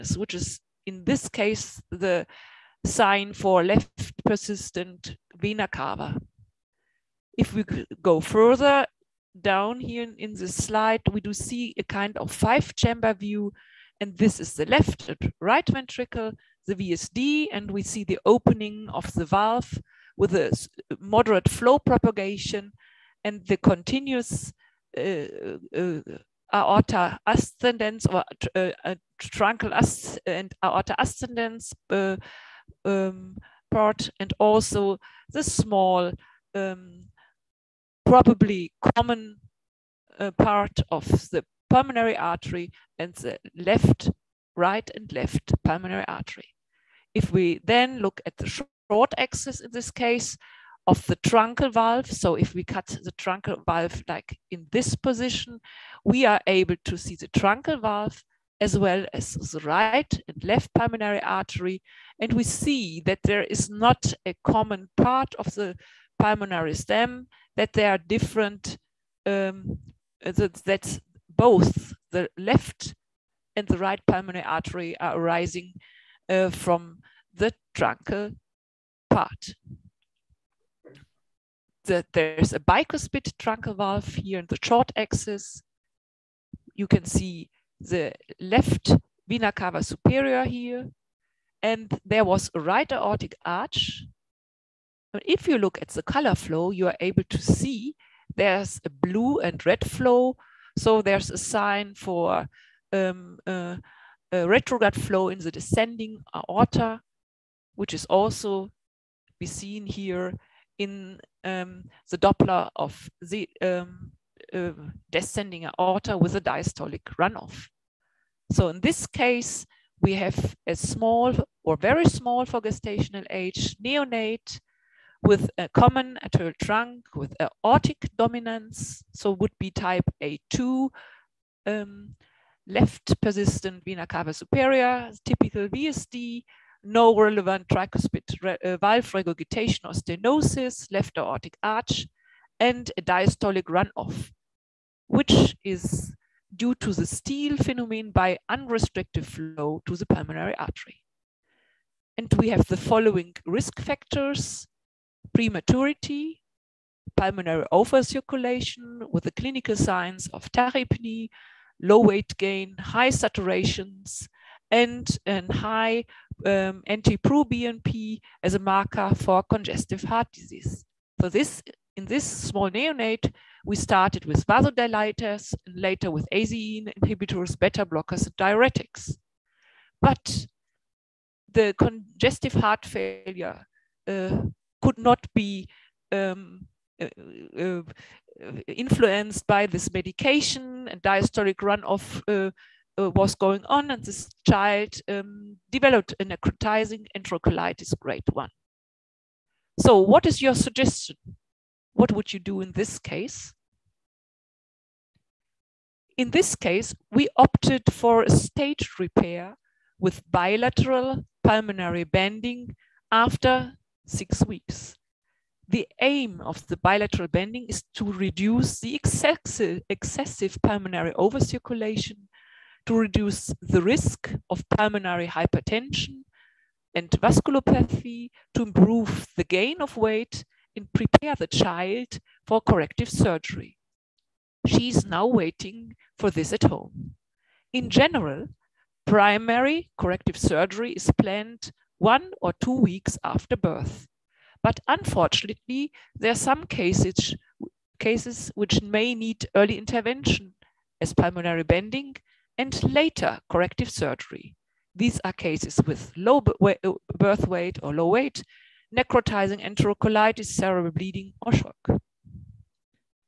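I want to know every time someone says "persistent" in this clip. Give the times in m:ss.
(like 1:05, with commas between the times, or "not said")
0:04, 2:13.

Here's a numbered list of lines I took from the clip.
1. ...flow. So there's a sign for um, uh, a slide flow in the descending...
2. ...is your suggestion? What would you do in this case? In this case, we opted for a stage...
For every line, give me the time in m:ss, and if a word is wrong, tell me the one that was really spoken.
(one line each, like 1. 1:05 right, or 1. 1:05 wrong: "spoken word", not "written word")
1. 1:39 wrong: "retrograde", not "slide"
2. 3:20 right.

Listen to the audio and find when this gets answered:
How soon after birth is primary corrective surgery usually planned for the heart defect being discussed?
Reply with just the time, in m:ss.
4:01.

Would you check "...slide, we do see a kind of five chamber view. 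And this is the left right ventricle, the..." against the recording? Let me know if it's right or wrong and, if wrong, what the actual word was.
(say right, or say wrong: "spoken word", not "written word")
right.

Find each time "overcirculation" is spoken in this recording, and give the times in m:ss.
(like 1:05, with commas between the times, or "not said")
2:37, 3:41.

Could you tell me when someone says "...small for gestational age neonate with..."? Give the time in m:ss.
2:02.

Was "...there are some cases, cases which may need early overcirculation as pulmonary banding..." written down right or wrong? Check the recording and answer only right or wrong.
wrong.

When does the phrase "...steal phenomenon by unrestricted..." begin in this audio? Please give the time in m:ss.
2:27.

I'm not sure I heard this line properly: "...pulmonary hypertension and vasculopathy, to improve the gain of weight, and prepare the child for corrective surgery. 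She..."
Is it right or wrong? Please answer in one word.
right.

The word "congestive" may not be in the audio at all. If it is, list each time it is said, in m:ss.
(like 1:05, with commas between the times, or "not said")
2:49, 3:01.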